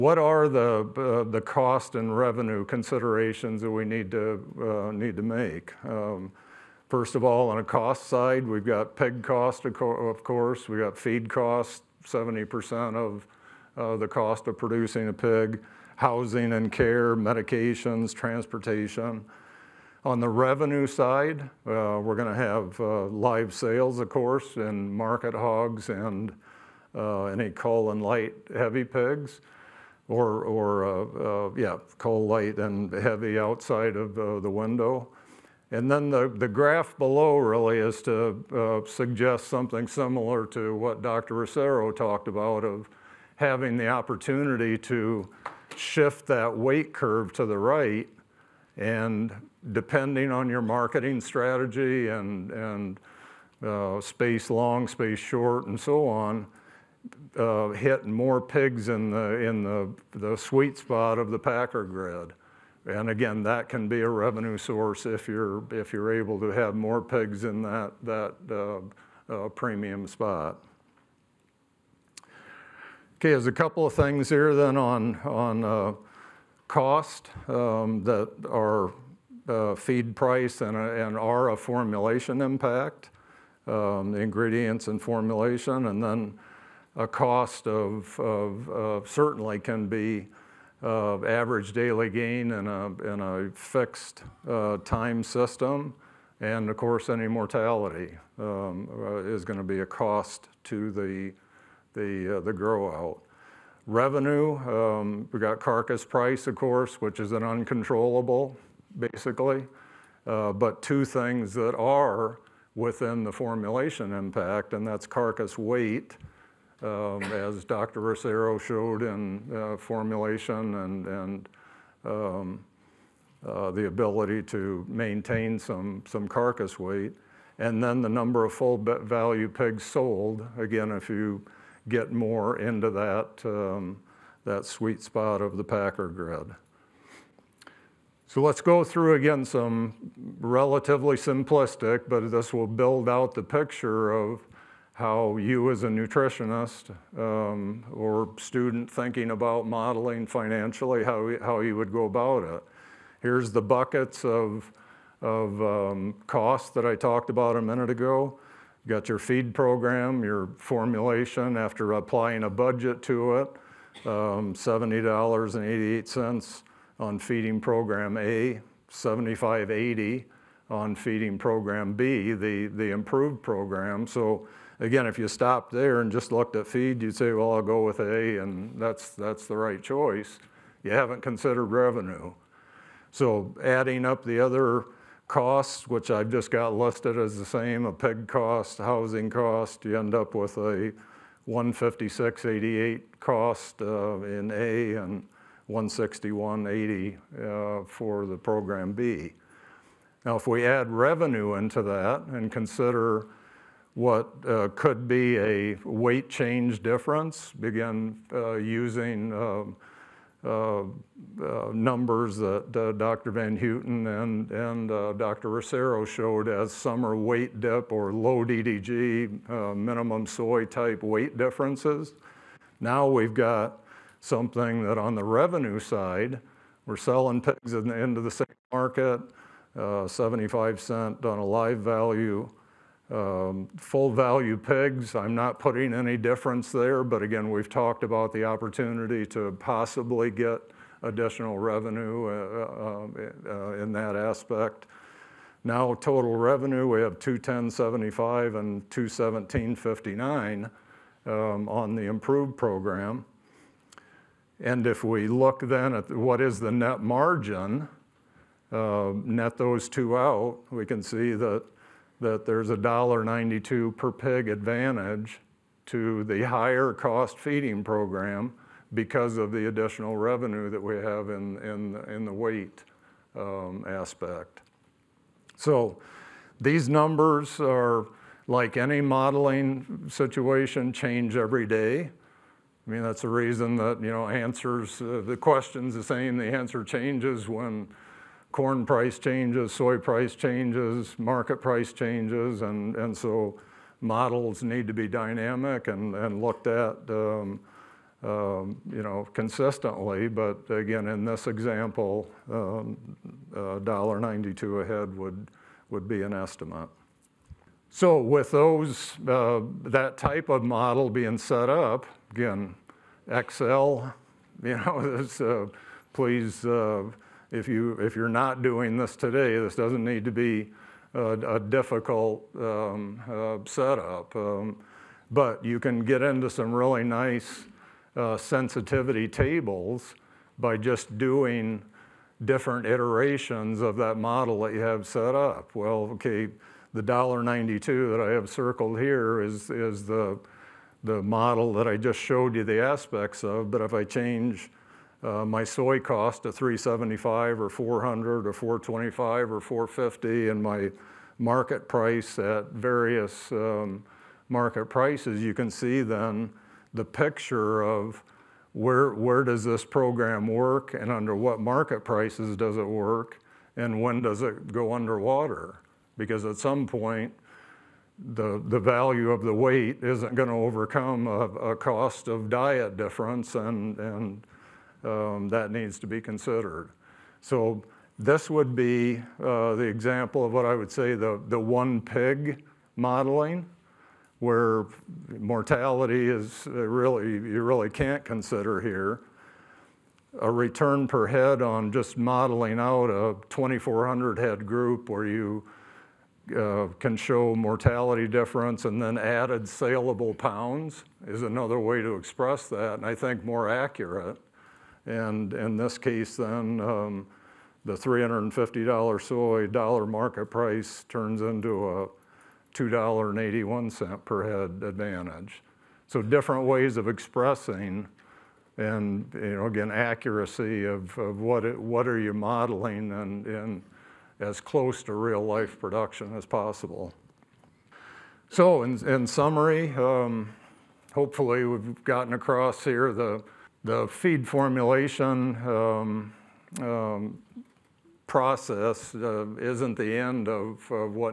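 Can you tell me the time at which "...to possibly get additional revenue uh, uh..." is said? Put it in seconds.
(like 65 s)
239 s.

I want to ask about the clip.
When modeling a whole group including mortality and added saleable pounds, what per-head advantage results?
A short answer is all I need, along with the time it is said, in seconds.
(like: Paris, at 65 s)
$2.81, at 412 s.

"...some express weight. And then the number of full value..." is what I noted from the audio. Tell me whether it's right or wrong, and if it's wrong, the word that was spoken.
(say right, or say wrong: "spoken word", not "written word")
wrong: "carcass", not "express".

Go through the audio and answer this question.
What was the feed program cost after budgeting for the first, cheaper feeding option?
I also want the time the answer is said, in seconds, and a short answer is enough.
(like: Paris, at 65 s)
$70.88, at 164 s.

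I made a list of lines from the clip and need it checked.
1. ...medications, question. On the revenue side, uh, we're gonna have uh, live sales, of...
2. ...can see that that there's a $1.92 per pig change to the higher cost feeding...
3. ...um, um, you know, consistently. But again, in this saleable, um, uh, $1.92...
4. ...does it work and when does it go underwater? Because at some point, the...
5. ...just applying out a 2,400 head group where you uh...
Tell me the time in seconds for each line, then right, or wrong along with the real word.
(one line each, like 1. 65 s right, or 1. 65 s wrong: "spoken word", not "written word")
1. 17 s wrong: "transportation", not "question"
2. 260 s wrong: "advantage", not "change"
3. 297 s wrong: "example", not "saleable"
4. 362 s right
5. 391 s wrong: "modeling", not "applying".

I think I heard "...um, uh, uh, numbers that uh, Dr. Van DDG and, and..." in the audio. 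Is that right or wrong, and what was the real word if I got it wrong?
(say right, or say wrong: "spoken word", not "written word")
wrong: "Houten", not "DDG".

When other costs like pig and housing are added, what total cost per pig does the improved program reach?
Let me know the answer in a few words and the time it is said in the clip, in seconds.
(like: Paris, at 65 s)
161.80, at 195 s.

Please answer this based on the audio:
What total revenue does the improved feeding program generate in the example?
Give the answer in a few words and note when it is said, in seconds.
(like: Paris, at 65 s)
217.59, at 248 s.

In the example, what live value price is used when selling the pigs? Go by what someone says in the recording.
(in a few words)
75 cents.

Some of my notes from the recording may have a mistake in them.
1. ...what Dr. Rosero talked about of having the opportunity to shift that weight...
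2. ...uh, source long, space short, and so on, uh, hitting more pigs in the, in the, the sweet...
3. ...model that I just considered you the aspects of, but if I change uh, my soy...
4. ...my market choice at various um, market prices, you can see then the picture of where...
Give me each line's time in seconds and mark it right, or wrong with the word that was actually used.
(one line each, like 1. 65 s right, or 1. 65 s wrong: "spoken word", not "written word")
1. 40 s right
2. 53 s wrong: "space", not "source"
3. 341 s wrong: "showed", not "considered"
4. 350 s wrong: "price", not "choice".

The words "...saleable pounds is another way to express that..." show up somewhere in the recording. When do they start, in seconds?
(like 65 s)
399 s.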